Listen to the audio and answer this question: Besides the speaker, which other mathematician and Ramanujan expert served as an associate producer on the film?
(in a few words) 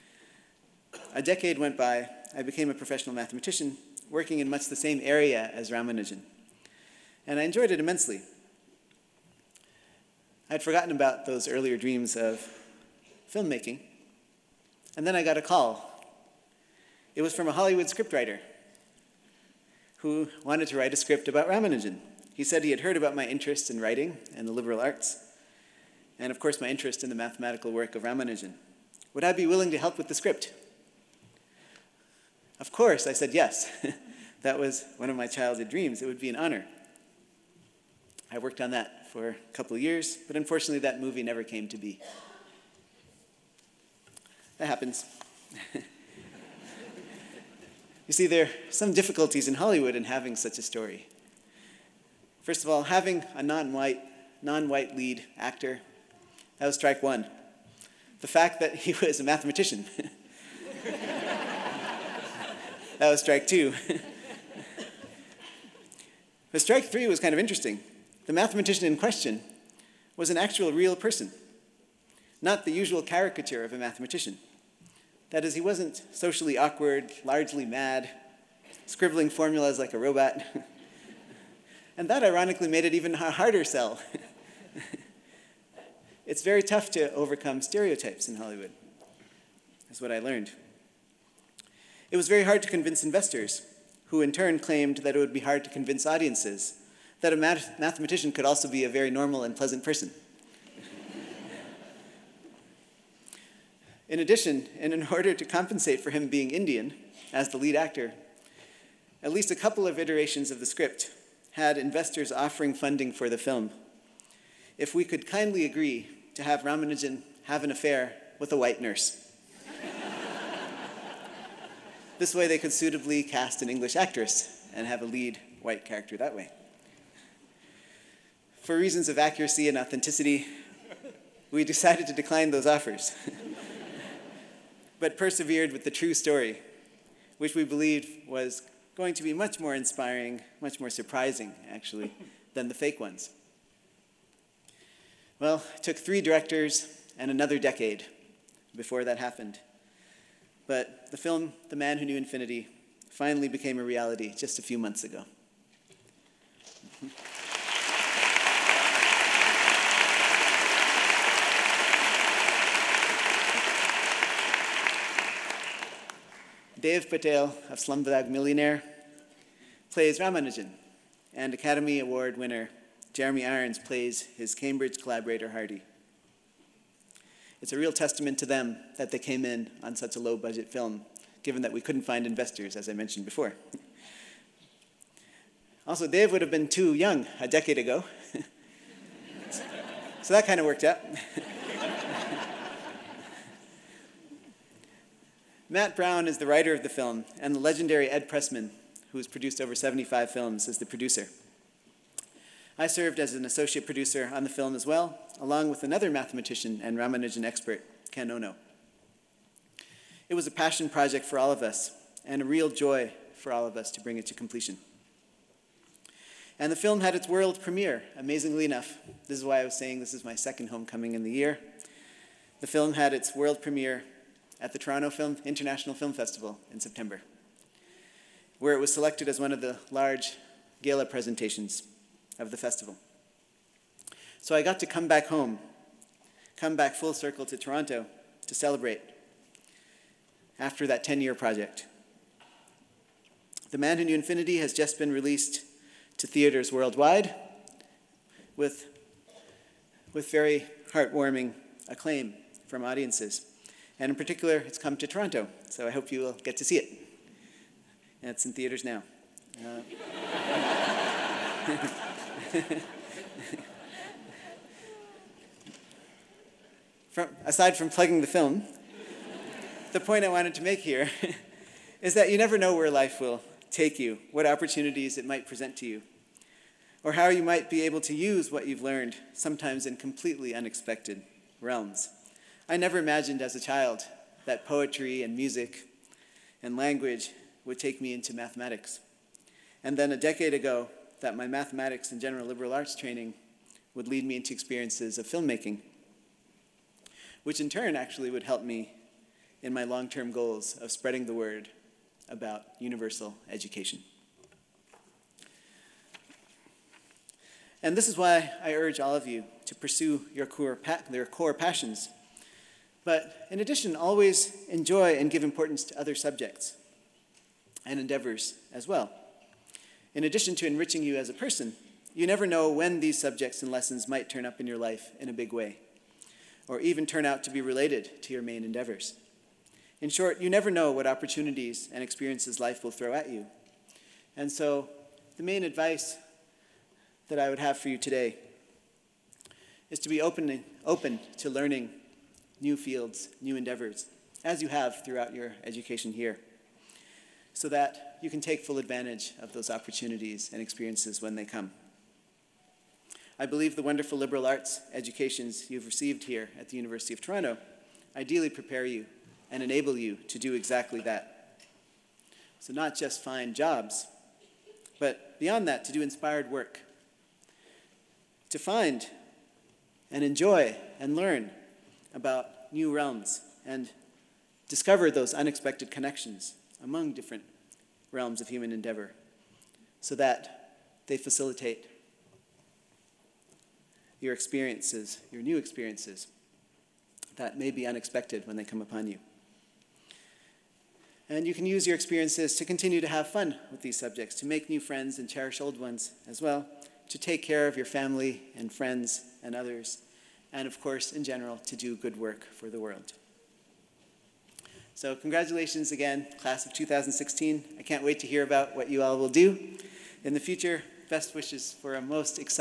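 Ken Ono.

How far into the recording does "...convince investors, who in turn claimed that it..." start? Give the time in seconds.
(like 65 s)
92 s.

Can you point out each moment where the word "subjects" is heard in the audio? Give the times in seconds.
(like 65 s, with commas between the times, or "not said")
316 s, 323 s, 393 s.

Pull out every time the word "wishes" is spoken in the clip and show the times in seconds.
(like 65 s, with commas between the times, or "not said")
411 s.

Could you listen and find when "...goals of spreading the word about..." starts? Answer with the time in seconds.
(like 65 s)
300 s.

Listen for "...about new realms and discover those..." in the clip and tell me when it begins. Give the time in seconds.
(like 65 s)
372 s.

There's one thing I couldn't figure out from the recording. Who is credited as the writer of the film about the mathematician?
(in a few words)
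Matt Brown.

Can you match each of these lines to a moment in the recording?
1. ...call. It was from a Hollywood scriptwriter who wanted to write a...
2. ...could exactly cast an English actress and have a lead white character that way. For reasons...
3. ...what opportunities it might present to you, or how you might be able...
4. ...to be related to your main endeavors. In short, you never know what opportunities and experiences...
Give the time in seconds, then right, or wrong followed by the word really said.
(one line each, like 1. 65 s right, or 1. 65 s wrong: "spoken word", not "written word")
1. 15 s right
2. 122 s wrong: "suitably", not "exactly"
3. 274 s right
4. 327 s right.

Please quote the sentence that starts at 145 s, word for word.
Well, it took three directors and another decade before that happened.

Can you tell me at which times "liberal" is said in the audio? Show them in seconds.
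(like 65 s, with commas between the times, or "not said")
24 s, 292 s, 354 s.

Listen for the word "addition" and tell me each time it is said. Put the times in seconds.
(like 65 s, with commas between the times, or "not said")
104 s, 313 s, 320 s.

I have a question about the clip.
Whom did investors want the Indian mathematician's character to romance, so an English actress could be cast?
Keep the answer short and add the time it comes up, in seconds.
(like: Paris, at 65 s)
a white nurse, at 118 s.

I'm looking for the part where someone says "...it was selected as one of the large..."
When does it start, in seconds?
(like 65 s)
228 s.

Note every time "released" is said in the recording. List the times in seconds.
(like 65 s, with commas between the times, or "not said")
245 s.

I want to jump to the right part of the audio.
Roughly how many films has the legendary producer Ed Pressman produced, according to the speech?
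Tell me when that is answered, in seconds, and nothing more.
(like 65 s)
199 s.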